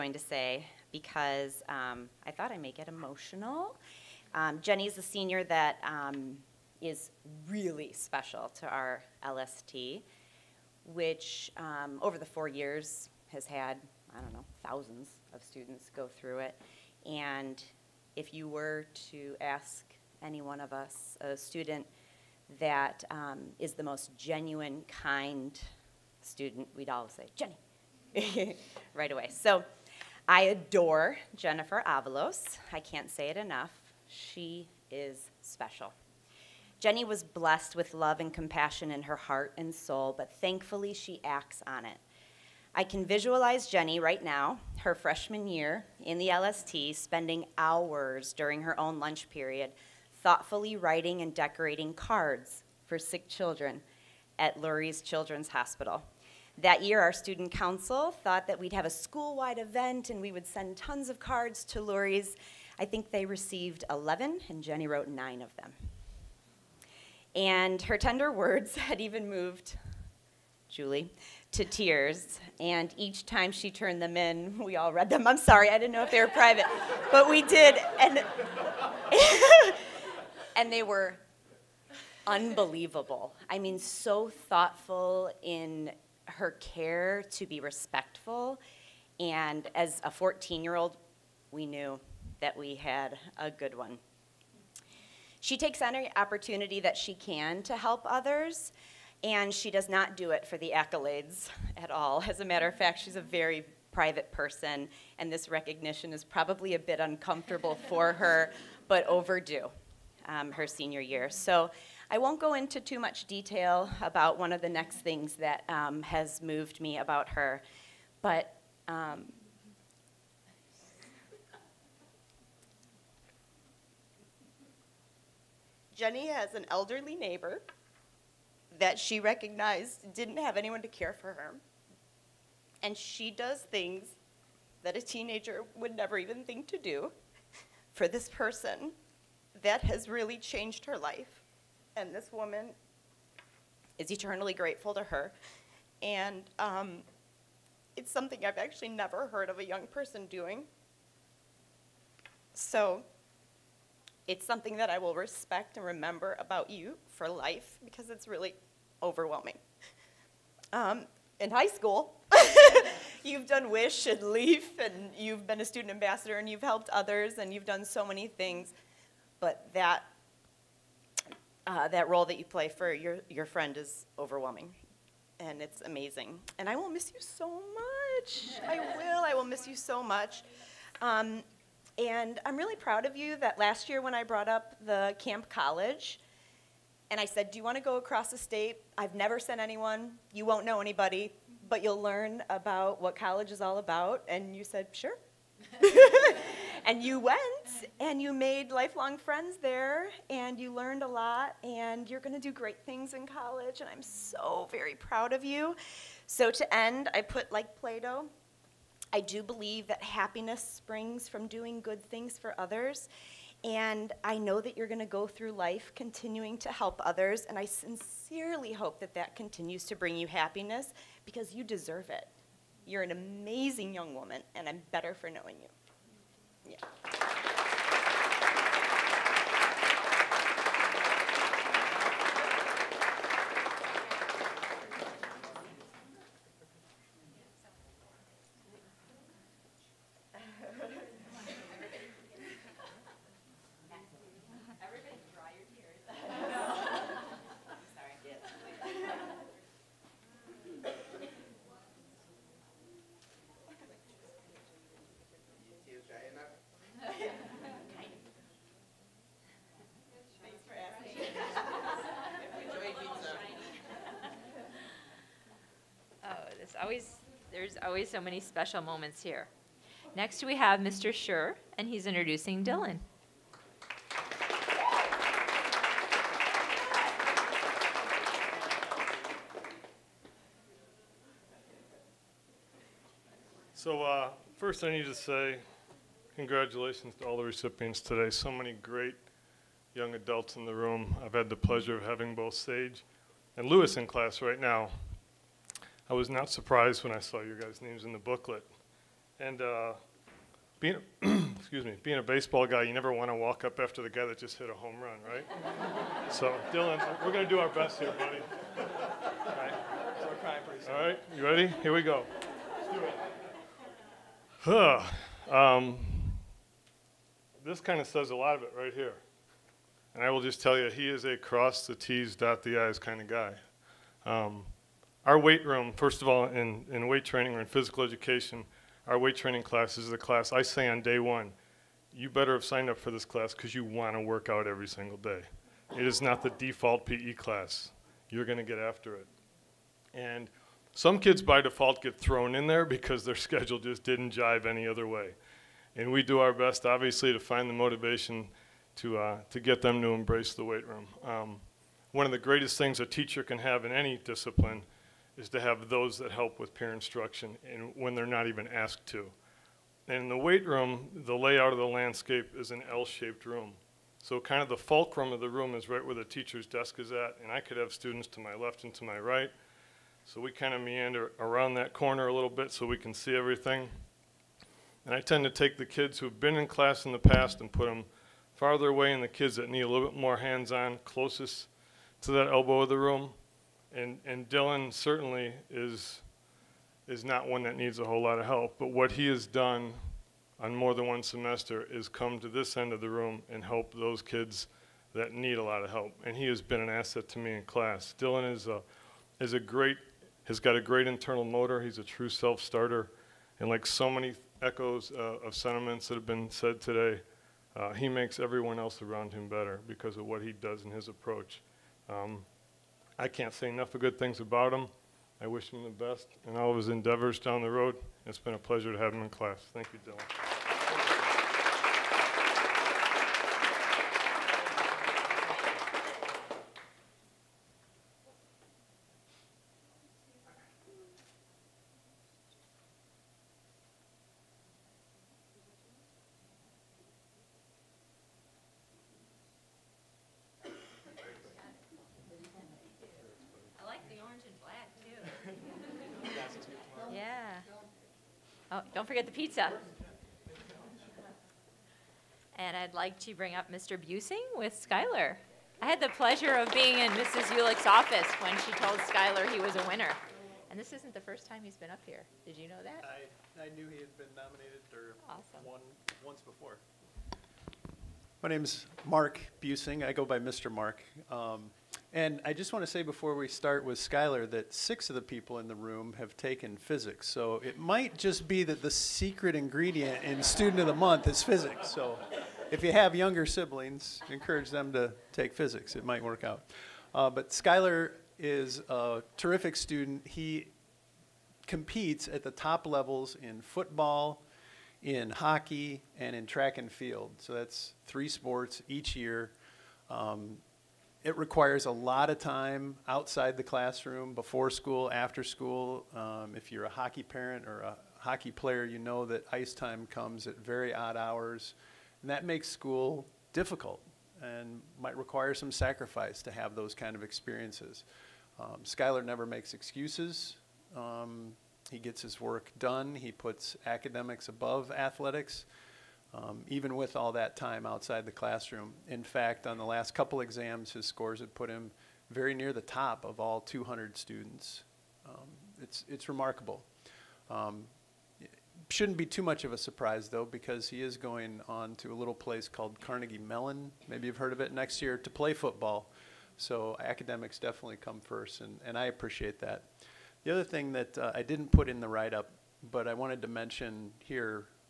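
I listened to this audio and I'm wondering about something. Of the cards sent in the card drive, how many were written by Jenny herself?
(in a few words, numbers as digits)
9.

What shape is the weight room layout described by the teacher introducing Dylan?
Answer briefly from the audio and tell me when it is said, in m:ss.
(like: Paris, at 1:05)
L-shaped, at 6:02.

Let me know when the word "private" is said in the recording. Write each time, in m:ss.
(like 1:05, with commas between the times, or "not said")
1:16, 1:43.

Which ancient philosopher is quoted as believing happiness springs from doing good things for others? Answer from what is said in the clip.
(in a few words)
Plato.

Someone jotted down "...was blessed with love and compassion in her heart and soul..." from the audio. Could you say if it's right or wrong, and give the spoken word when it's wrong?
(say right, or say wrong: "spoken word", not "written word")
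right.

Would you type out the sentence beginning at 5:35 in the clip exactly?
It is not the default PE class.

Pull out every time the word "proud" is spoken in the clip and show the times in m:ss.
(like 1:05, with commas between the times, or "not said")
3:02, 3:24.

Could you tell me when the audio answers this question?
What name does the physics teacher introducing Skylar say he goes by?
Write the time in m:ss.
7:50.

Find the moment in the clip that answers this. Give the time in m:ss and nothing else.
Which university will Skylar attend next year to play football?
9:03.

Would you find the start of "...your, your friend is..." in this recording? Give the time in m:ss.
2:52.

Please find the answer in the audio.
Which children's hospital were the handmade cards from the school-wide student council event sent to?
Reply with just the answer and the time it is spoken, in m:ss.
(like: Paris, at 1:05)
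Lurie's Children's Hospital, at 0:54.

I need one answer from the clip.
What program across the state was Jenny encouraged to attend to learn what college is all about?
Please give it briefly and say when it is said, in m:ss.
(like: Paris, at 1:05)
Camp College, at 3:05.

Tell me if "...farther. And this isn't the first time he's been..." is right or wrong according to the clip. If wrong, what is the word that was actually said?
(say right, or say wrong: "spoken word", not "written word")
wrong: "winner", not "farther".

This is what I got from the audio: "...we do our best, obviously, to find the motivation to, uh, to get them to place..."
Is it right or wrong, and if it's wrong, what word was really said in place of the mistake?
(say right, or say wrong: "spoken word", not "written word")
wrong: "embrace", not "place".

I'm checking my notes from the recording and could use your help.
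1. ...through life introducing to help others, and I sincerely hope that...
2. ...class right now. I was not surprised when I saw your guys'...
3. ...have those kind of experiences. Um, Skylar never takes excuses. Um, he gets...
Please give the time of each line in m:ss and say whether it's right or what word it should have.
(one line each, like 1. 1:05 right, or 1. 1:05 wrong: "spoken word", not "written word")
1. 3:35 wrong: "continuing", not "introducing"
2. 4:54 right
3. 8:36 wrong: "makes", not "takes".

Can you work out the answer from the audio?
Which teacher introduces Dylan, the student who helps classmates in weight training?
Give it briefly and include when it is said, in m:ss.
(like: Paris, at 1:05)
Mr. Schur, at 4:30.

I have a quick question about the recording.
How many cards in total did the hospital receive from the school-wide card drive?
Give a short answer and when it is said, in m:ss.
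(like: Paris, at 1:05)
11, at 1:03.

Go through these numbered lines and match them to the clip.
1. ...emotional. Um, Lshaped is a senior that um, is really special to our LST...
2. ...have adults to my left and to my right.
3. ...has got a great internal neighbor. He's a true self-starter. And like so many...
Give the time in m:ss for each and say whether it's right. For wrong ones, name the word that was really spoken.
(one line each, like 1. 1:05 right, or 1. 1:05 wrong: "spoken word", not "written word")
1. 0:02 wrong: "Jenny", not "Lshaped"
2. 6:07 wrong: "students", not "adults"
3. 6:40 wrong: "motor", not "neighbor".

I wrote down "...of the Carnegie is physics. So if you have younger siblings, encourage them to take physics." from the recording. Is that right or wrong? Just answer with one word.
wrong.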